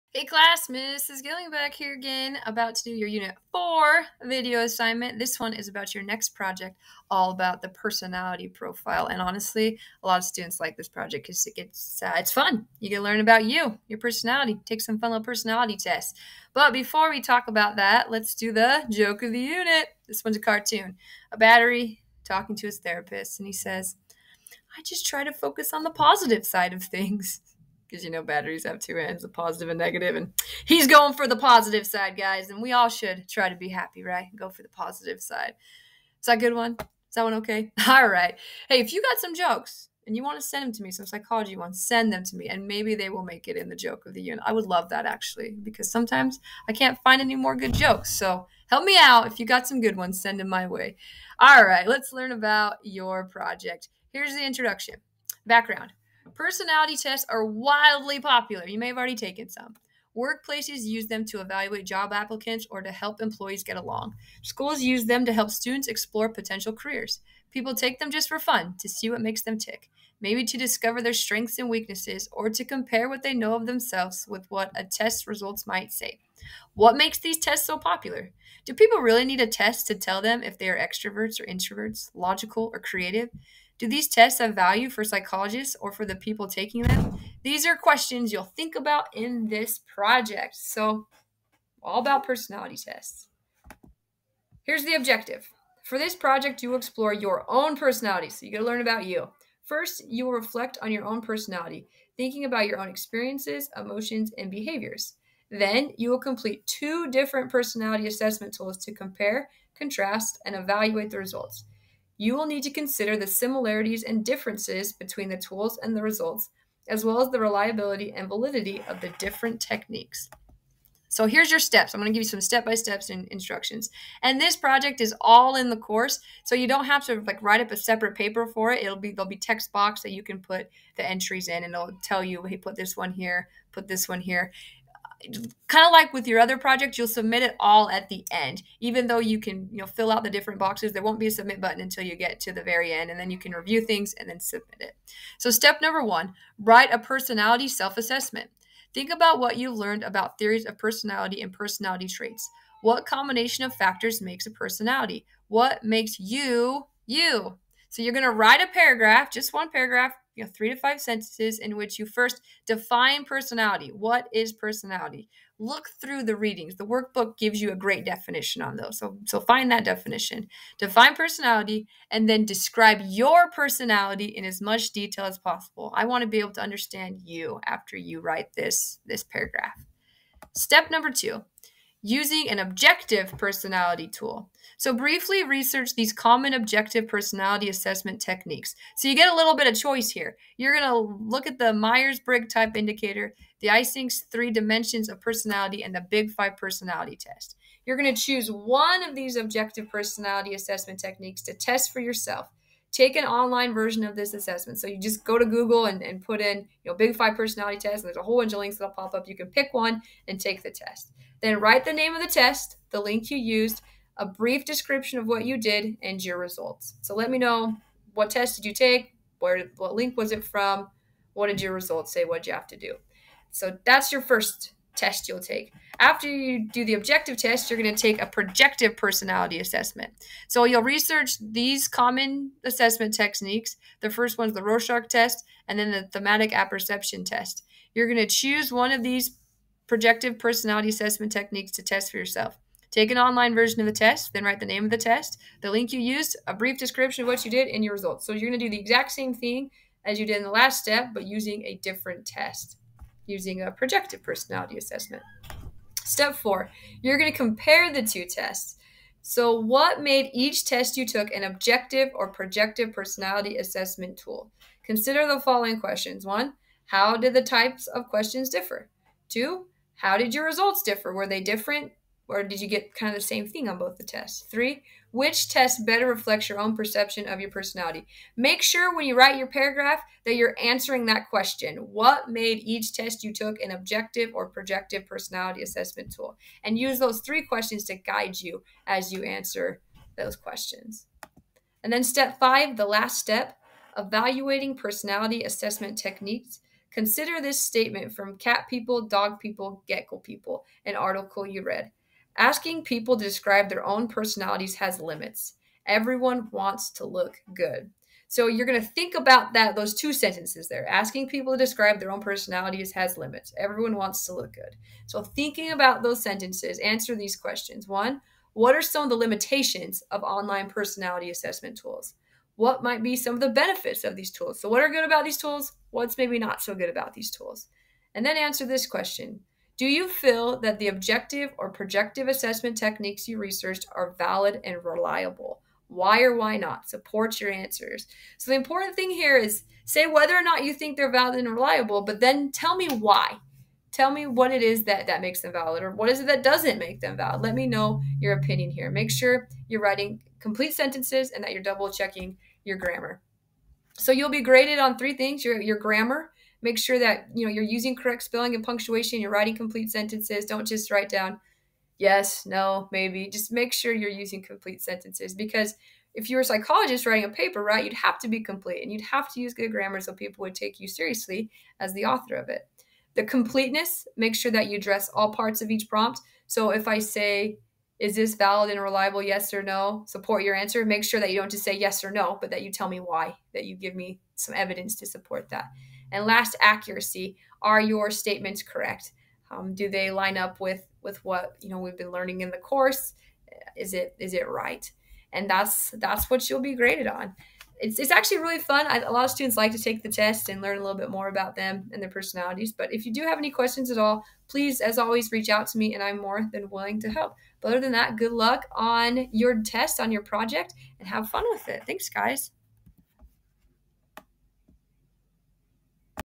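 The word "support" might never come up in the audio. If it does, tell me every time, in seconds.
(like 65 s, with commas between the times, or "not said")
336 s, 380 s, 385 s.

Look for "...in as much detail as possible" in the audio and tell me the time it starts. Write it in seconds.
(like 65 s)
174 s.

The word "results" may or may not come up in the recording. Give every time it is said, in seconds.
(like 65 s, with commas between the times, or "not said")
75 s, 111 s, 116 s, 216 s, 221 s, 247 s, 270 s.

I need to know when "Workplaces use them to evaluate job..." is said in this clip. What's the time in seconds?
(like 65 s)
60 s.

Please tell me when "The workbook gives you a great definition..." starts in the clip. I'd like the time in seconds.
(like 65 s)
166 s.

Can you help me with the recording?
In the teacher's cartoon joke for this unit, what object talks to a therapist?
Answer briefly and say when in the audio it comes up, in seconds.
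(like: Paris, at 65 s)
A battery, at 21 s.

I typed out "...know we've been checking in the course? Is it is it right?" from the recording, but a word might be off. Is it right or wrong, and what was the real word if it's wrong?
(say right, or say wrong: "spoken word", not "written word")
wrong: "learning", not "checking".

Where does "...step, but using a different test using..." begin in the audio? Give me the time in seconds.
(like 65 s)
250 s.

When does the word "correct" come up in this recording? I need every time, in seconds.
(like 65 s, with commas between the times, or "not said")
357 s, 388 s.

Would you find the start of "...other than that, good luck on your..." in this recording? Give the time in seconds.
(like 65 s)
407 s.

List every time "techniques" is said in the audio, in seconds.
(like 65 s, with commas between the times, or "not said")
119 s, 188 s, 200 s, 233 s, 241 s, 295 s, 332 s.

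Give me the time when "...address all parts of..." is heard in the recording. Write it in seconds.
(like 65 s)
374 s.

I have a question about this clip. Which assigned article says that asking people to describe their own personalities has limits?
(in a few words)
Cat People, Dog People, Gecko People.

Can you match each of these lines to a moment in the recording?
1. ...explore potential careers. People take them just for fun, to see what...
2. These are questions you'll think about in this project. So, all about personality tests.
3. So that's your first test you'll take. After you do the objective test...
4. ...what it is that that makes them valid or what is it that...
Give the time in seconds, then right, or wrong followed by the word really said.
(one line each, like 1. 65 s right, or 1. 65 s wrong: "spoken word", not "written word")
1. 65 s right
2. 87 s right
3. 223 s right
4. 344 s right.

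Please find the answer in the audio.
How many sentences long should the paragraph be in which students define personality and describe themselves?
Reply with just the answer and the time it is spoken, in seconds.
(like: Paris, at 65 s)
3 to 5, at 160 s.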